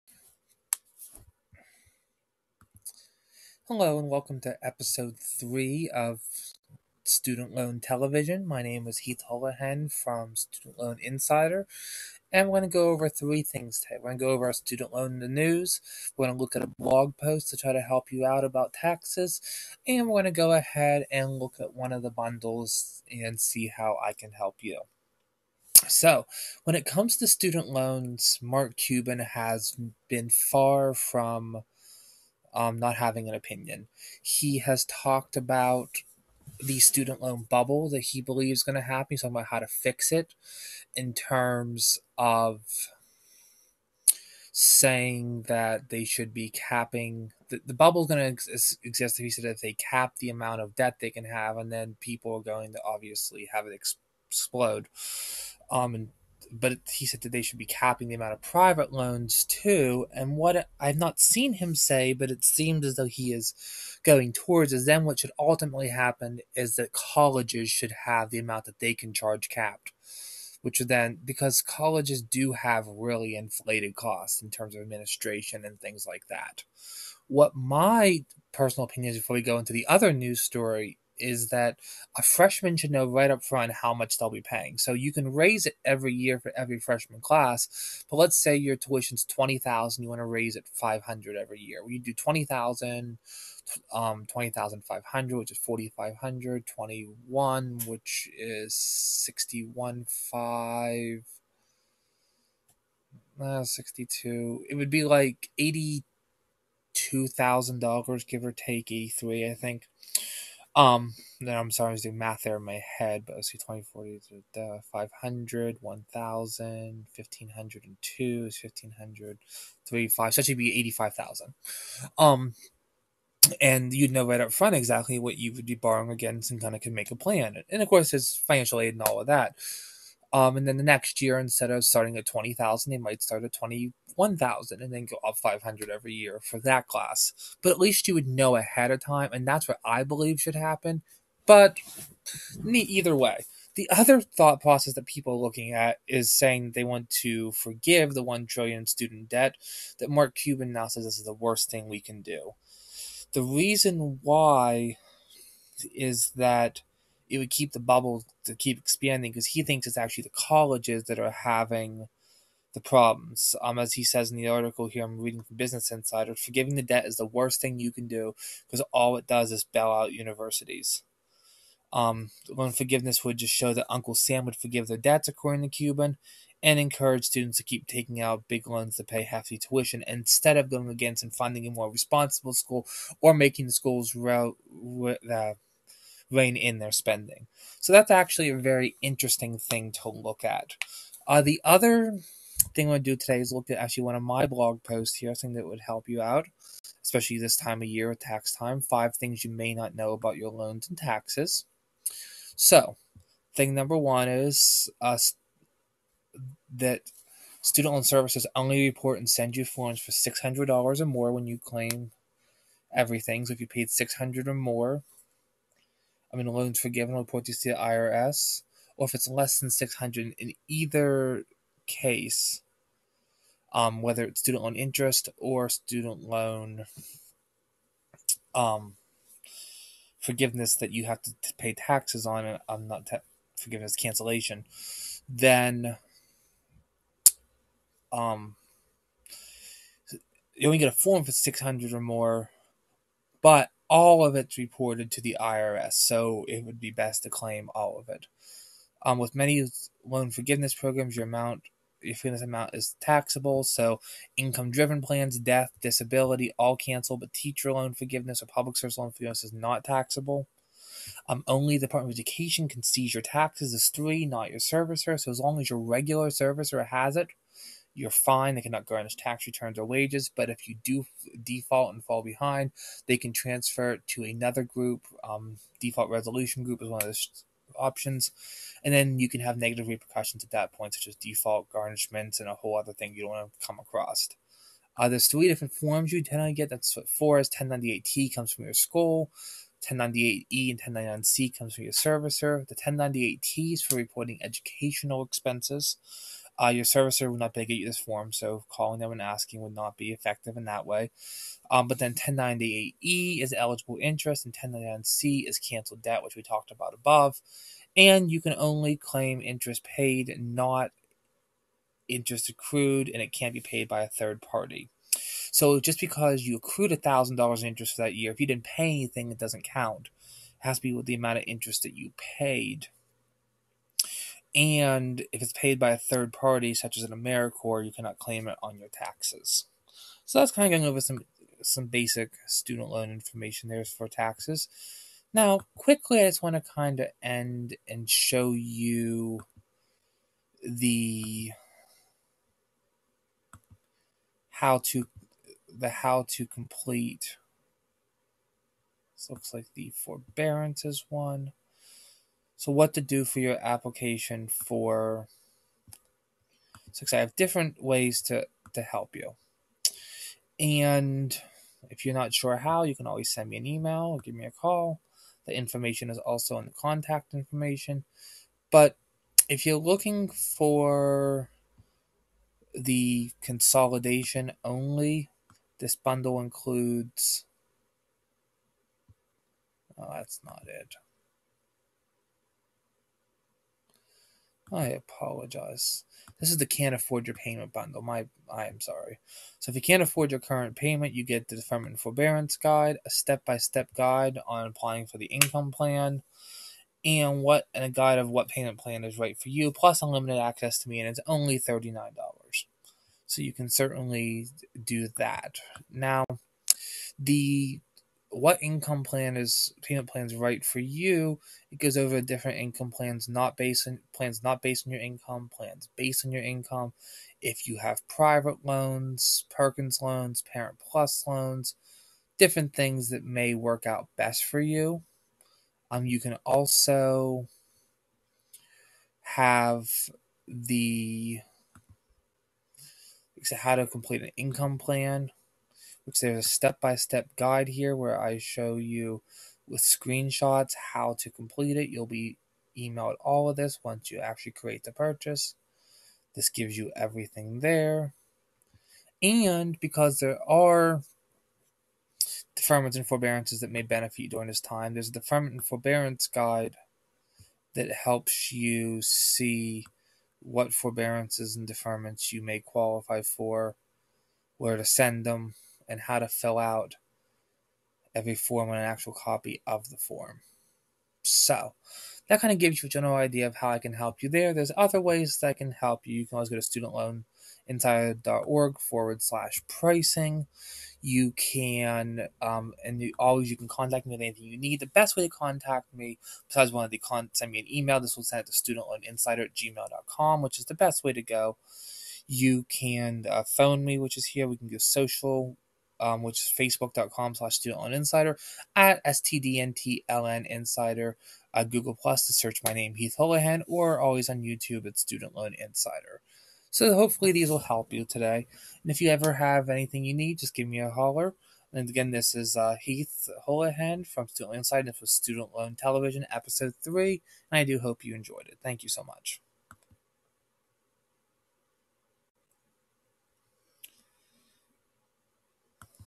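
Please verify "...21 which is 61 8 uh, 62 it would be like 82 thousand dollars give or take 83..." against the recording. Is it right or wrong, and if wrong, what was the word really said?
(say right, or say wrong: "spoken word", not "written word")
wrong: "5", not "8".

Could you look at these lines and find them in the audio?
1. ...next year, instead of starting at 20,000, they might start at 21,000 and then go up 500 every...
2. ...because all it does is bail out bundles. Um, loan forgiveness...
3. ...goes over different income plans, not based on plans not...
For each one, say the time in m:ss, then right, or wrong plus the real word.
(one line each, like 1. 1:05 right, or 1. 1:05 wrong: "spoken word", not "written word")
1. 2:10 right
2. 2:48 wrong: "universities", not "bundles"
3. 6:51 right.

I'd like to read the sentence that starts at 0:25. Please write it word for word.
So, when it comes to student loans, Mark Cuban has been far from um, not having an opinion.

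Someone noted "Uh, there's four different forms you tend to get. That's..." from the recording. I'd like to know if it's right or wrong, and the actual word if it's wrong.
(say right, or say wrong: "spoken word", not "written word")
wrong: "three", not "four".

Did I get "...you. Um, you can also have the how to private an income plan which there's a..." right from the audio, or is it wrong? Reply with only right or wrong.
wrong.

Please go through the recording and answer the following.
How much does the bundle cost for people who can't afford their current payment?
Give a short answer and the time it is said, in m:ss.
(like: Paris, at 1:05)
$39, at 6:41.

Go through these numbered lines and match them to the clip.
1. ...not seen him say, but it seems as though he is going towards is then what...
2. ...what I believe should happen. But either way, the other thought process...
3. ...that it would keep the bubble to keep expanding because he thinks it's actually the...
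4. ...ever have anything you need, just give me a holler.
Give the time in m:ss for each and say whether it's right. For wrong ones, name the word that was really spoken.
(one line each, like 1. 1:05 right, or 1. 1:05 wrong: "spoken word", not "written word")
1. 1:00 right
2. 2:19 right
3. 2:36 right
4. 8:29 right.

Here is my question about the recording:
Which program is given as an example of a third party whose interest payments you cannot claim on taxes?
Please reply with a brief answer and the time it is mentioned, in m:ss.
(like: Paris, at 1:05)
AmeriCorps, at 5:27.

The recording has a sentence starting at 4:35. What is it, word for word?
Um, default resolution group is one of the options.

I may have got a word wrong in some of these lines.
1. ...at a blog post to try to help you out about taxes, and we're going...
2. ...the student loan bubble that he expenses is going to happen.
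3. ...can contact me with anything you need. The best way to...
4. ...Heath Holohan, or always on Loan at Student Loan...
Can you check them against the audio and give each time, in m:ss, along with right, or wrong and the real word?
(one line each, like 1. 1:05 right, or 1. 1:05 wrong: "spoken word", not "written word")
1. 0:16 right
2. 0:36 wrong: "believes", not "expenses"
3. 8:03 right
4. 8:22 wrong: "YouTube", not "Loan".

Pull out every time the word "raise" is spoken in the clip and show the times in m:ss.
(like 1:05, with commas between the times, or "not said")
1:25, 1:30.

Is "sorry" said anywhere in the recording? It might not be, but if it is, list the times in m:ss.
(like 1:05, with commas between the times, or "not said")
1:51, 6:28.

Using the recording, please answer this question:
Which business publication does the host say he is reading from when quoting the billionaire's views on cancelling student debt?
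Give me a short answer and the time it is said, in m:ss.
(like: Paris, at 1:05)
Business Insider, at 2:45.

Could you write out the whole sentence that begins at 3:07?
So that's actually a very interesting thing to look at.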